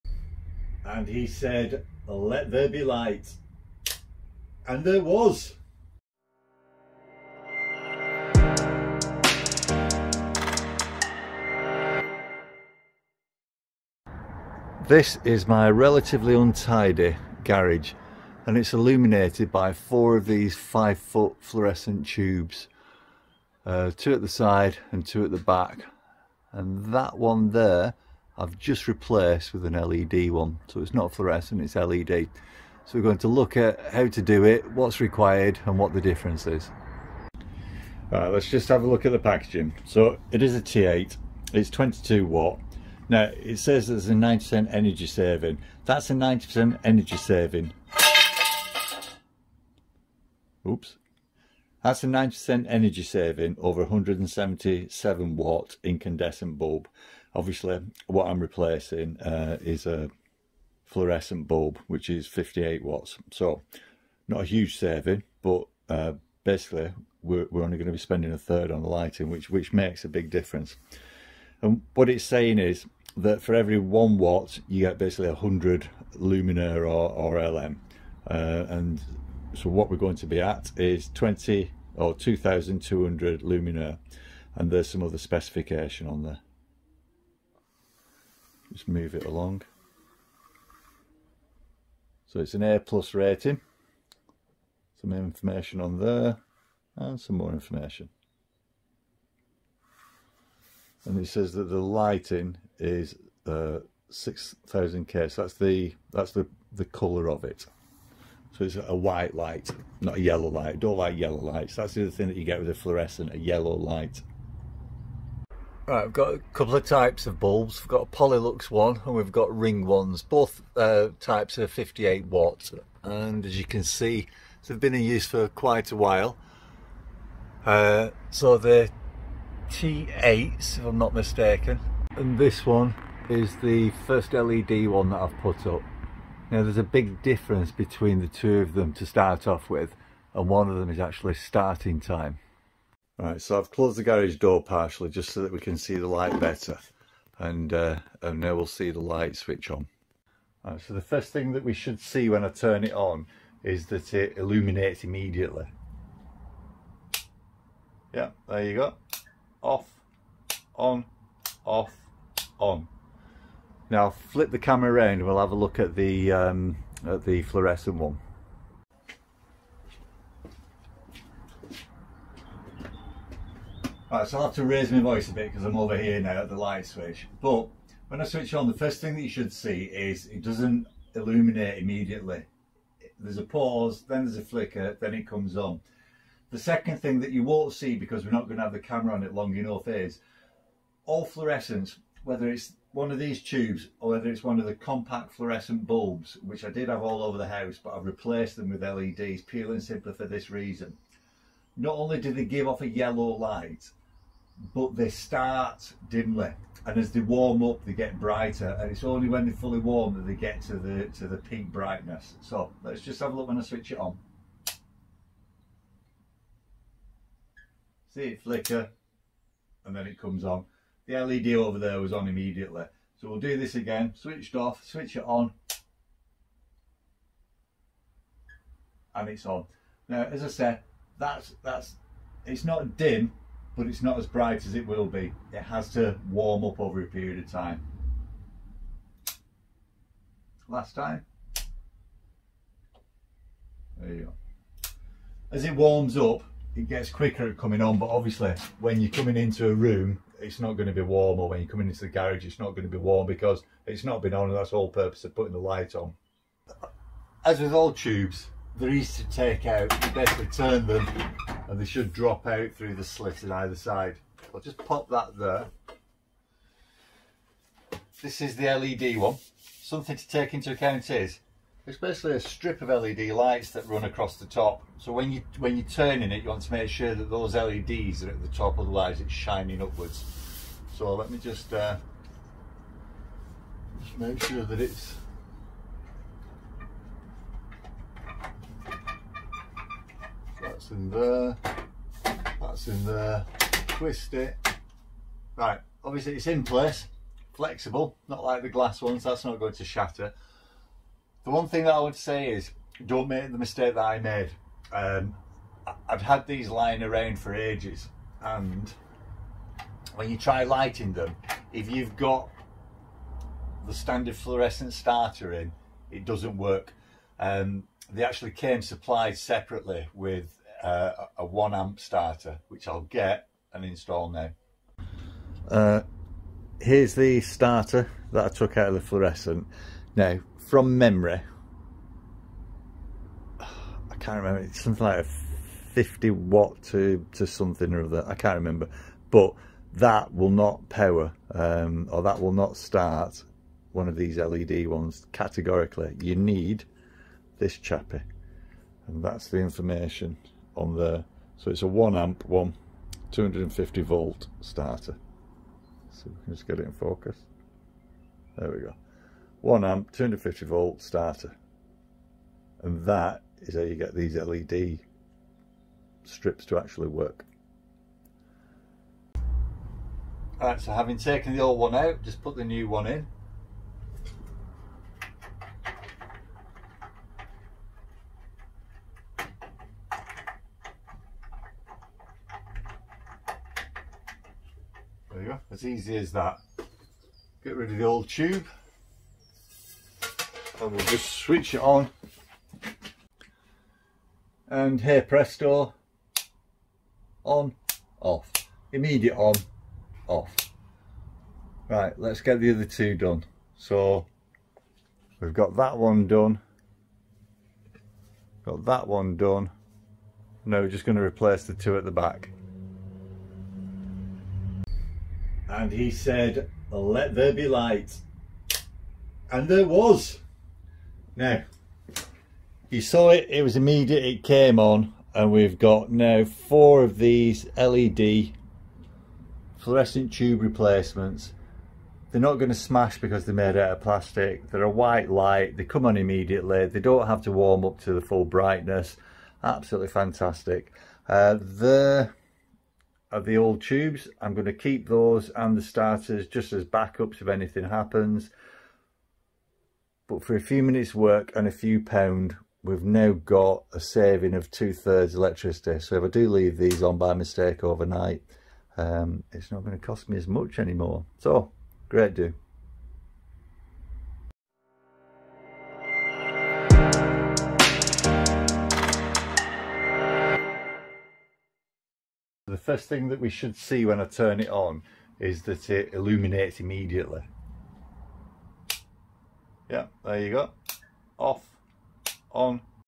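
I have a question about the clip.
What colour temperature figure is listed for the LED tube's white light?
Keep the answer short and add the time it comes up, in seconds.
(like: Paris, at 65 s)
6000k, at 104 s.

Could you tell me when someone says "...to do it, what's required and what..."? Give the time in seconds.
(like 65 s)
34 s.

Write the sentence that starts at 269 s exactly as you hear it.
Something to take into account is it's basically a strip of LED lights that run across the top.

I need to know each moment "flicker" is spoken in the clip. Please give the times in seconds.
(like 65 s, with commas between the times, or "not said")
184 s, 218 s.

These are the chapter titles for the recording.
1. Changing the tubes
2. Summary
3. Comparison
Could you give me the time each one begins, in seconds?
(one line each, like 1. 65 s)
1. 256 s
2. 422 s
3. 131 s.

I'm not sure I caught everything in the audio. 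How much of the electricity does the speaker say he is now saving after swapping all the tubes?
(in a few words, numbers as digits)
two thirds.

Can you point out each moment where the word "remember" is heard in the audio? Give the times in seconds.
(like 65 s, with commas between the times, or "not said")
334 s, 338 s.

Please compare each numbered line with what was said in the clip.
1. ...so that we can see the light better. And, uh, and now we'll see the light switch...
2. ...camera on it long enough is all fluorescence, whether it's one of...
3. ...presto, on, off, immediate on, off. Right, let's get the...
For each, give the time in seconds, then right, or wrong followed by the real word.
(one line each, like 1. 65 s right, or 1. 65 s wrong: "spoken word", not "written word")
1. 145 s right
2. 188 s right
3. 395 s right.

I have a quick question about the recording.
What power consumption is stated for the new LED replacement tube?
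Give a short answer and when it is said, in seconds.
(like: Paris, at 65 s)
22 watts, at 41 s.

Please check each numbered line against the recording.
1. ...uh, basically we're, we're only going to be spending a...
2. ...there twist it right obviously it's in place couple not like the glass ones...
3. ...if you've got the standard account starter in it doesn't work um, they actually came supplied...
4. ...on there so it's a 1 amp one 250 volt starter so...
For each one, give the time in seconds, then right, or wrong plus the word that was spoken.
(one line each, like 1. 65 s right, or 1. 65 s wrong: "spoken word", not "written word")
1. 65 s right
2. 293 s wrong: "flexible", not "couple"
3. 311 s wrong: "fluorescent", not "account"
4. 350 s right.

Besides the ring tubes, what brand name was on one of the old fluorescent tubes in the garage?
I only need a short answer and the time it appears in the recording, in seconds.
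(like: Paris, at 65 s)
Polylux, at 118 s.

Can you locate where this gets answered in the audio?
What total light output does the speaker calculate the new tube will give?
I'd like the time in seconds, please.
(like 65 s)
82 s.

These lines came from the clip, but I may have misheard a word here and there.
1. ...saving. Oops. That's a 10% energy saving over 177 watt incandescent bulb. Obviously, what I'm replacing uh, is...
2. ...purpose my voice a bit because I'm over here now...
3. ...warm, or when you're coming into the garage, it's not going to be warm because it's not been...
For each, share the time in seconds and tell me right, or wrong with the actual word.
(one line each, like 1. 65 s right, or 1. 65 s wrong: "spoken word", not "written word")
1. 47 s wrong: "90", not "10"
2. 174 s wrong: "raise", not "purpose"
3. 251 s right.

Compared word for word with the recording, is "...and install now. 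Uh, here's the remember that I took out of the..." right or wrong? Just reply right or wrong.
wrong.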